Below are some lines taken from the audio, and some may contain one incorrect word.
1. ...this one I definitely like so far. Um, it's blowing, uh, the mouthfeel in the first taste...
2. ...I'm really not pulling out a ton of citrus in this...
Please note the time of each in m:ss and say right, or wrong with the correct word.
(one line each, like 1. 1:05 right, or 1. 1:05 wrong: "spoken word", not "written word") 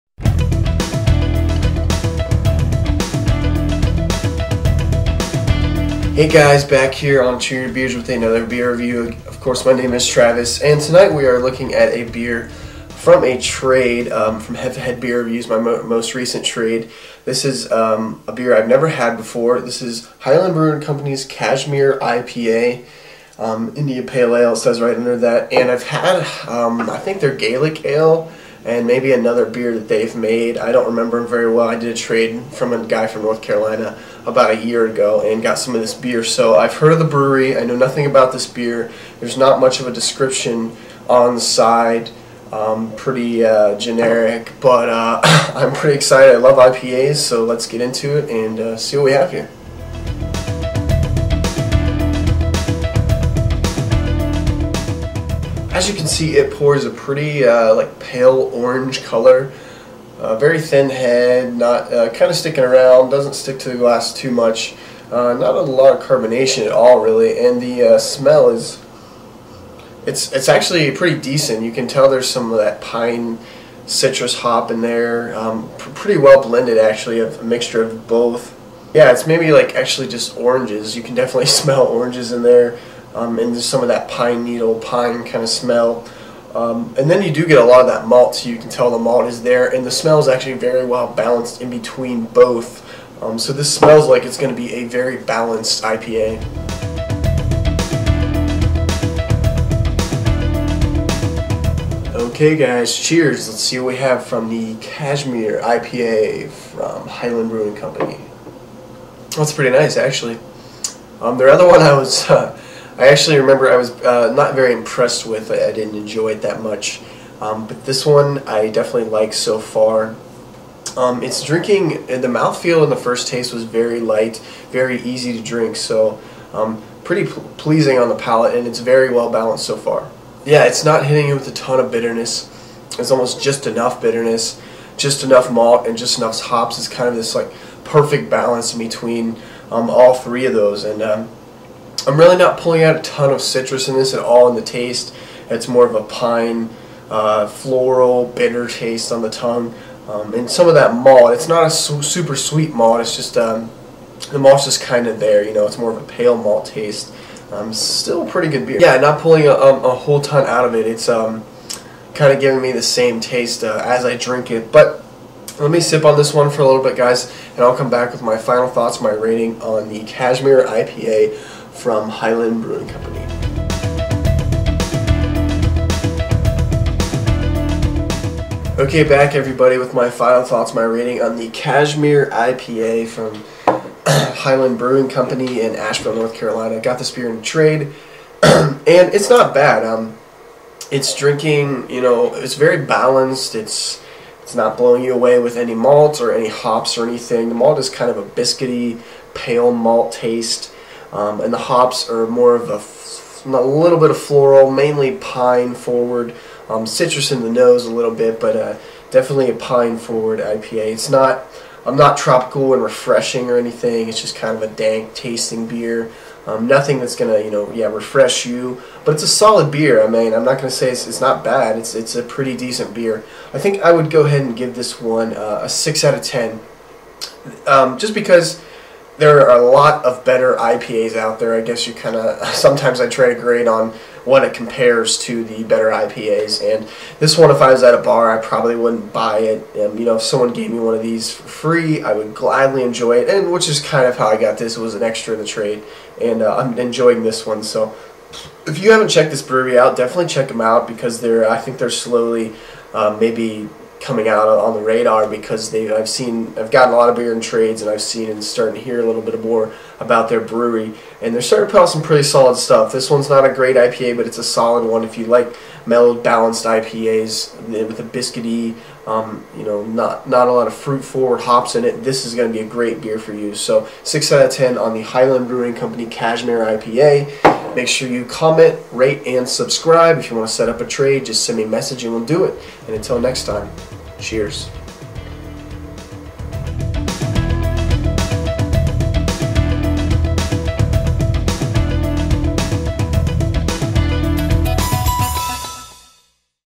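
1. 1:57 wrong: "drinking", not "blowing"
2. 2:22 right.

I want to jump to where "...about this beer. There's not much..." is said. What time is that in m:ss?
0:38.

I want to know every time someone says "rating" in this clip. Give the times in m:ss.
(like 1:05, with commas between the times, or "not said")
2:49, 3:00.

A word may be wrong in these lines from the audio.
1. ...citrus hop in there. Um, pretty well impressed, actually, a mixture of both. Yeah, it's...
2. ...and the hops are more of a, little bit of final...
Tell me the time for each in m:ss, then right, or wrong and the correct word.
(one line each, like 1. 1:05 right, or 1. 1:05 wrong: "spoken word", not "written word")
1. 1:13 wrong: "blended", not "impressed"
2. 3:21 wrong: "floral", not "final".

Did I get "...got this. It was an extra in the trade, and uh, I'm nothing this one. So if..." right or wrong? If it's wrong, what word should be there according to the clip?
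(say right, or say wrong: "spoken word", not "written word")
wrong: "enjoying", not "nothing".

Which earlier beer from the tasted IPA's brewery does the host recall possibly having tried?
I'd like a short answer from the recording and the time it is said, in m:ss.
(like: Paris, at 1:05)
Gaelic Ale, at 0:27.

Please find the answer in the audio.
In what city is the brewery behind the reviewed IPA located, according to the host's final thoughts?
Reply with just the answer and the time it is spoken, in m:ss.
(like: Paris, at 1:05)
Asheville, at 3:05.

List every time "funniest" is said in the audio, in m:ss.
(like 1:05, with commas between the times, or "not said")
not said.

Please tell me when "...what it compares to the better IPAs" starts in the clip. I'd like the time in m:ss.
3:54.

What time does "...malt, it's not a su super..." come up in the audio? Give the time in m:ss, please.
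2:30.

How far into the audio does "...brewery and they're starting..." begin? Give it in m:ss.
4:20.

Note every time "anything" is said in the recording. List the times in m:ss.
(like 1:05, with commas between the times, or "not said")
3:17, 3:33.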